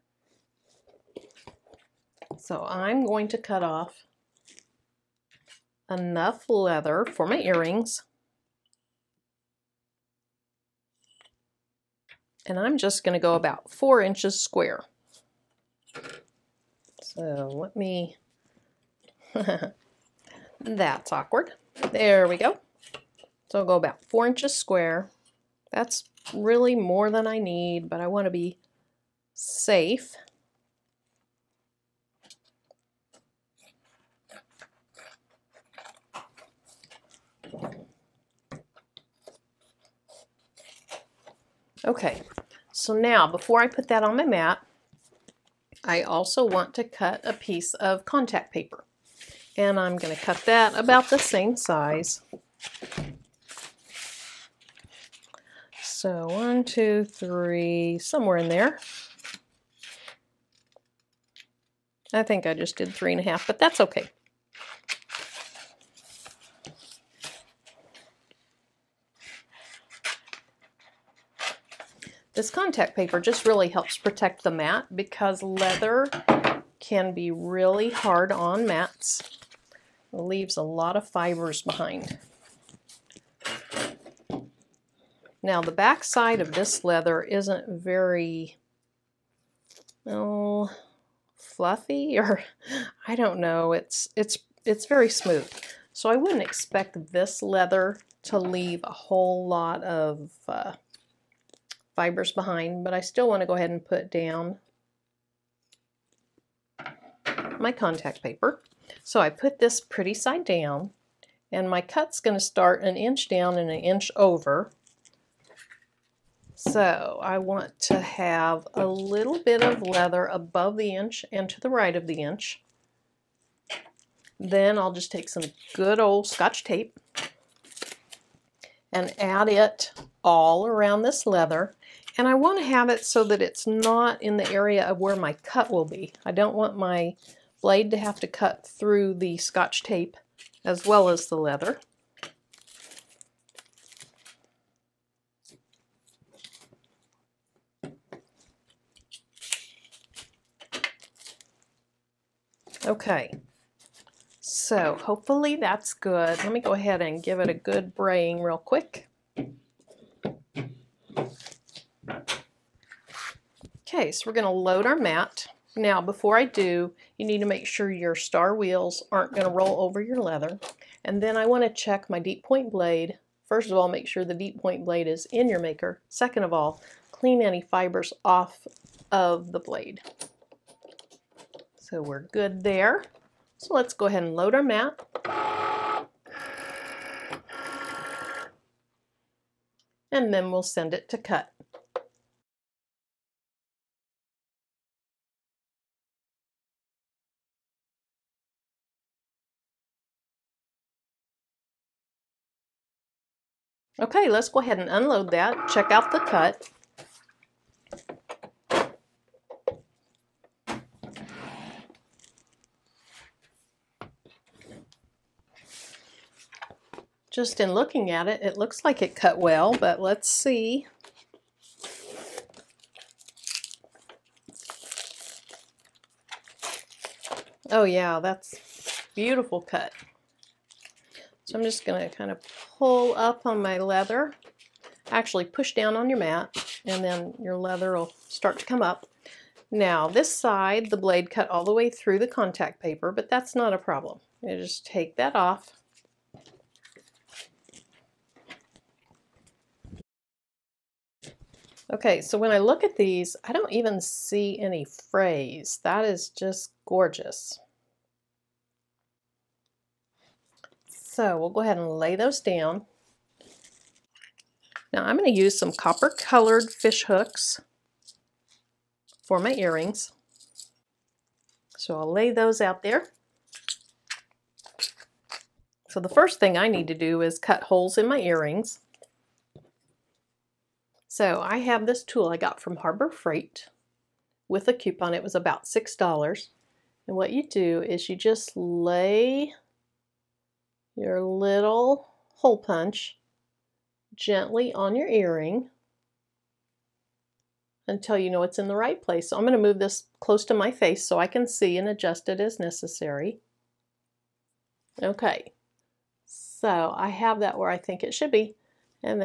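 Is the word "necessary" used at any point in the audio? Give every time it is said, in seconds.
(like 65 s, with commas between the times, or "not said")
302 s.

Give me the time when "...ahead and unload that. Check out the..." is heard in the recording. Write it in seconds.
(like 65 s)
204 s.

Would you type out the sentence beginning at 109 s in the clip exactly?
So I put this pretty side down and my cut's going to start an inch down and an inch over.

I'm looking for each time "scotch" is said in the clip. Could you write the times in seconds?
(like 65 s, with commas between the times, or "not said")
126 s, 139 s.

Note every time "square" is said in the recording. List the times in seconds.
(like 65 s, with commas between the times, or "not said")
14 s, 24 s.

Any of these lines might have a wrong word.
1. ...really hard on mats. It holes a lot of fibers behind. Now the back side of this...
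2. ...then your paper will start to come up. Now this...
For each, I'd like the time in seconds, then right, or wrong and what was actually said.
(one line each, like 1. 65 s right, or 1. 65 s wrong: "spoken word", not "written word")
1. 77 s wrong: "leaves", not "holes"
2. 237 s wrong: "leather", not "paper".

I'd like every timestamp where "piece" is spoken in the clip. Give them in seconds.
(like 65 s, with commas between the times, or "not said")
47 s.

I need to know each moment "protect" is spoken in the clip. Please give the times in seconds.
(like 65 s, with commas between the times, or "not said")
73 s.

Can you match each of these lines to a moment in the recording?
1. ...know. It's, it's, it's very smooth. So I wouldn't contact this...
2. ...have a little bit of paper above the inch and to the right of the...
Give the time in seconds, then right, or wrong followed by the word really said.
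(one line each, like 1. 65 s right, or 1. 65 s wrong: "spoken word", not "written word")
1. 93 s wrong: "expect", not "contact"
2. 117 s wrong: "leather", not "paper".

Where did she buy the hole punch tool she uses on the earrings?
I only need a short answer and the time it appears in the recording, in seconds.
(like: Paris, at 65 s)
Harbor Freight, at 282 s.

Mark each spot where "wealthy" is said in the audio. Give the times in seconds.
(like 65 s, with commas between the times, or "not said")
not said.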